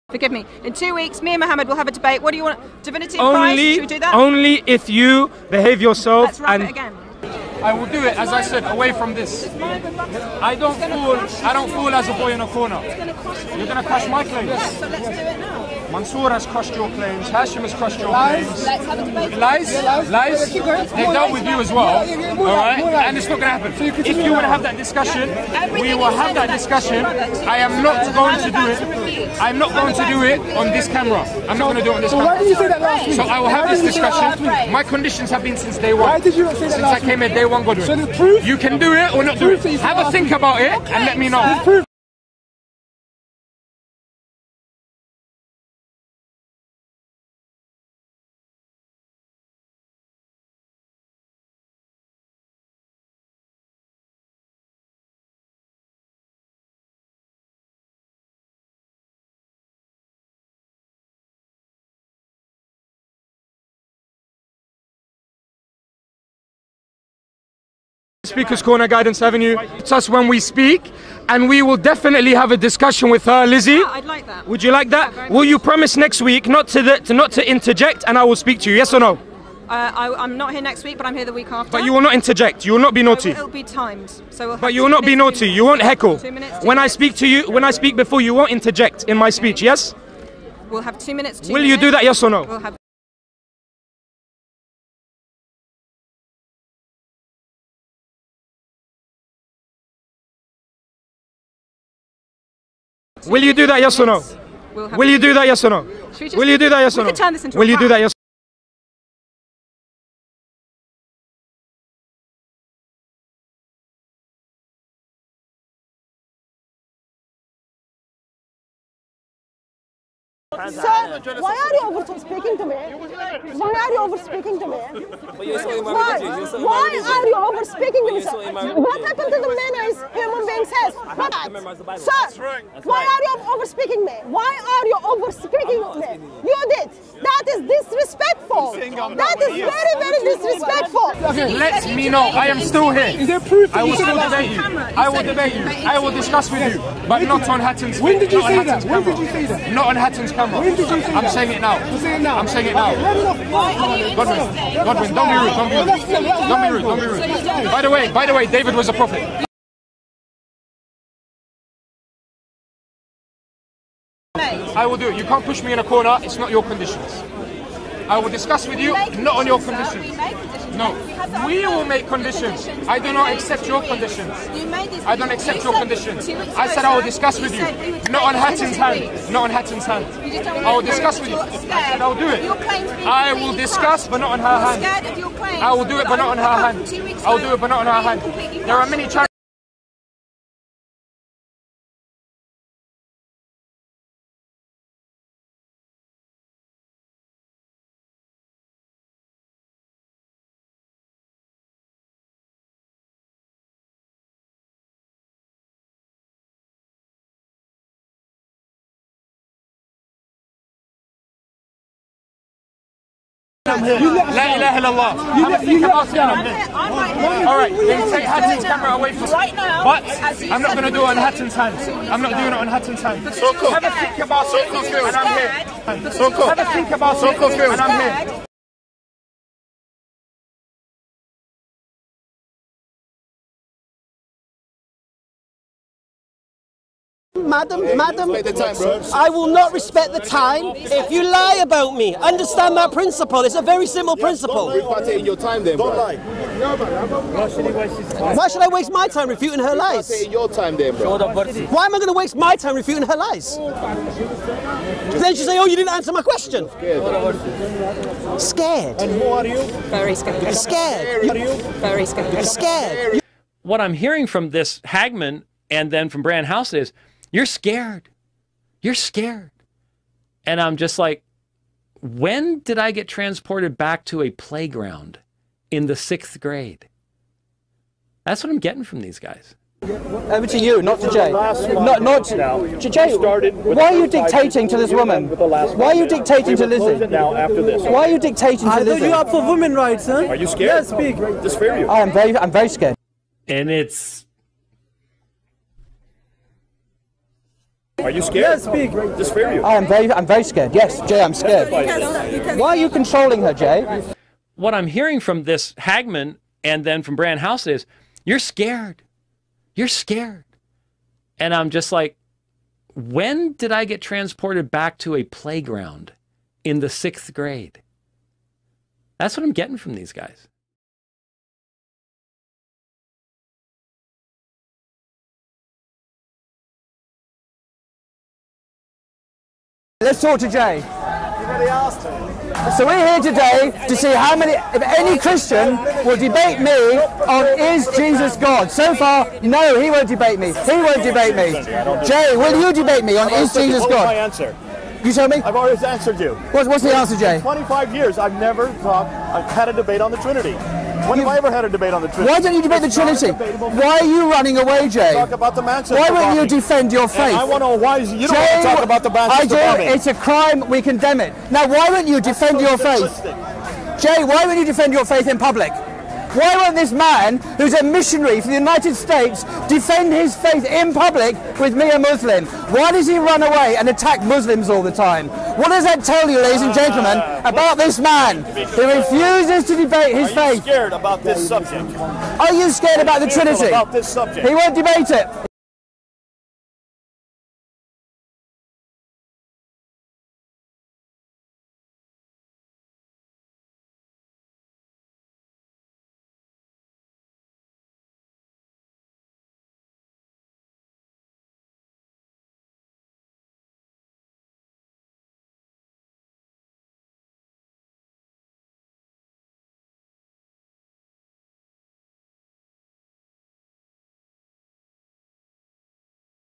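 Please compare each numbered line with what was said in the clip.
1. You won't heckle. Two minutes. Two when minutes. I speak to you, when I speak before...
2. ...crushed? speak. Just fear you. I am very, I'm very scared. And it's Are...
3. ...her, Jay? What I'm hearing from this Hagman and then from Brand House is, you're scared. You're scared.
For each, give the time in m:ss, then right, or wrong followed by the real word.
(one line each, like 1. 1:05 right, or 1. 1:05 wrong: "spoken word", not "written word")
1. 1:25 right
2. 4:50 wrong: "scared", not "crushed"
3. 5:03 right.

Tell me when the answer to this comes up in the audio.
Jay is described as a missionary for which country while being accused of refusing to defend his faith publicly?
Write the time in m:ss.
6:08.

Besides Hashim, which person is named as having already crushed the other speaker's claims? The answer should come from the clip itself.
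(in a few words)
Mansour.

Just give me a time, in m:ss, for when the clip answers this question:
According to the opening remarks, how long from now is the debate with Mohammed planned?
0:00.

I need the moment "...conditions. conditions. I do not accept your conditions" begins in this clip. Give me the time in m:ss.
2:52.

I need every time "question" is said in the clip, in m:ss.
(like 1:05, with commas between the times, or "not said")
4:16.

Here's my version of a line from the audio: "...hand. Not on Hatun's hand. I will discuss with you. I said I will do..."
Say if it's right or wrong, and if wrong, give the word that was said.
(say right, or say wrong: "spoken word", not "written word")
right.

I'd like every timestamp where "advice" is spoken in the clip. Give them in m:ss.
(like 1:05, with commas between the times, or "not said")
0:03.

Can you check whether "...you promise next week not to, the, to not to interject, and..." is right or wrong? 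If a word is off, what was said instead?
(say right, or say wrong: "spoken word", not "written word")
right.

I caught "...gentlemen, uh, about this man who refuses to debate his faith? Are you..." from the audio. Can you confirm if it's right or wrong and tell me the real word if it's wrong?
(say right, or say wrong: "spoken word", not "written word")
right.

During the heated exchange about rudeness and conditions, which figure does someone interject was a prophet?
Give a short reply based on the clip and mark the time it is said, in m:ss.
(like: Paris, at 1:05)
David, at 2:38.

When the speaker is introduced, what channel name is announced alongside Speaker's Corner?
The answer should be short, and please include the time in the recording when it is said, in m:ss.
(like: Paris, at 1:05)
Guidance Avenue, at 1:08.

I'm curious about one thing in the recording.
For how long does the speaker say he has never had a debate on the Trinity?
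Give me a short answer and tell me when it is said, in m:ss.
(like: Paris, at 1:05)
25 years, at 5:47.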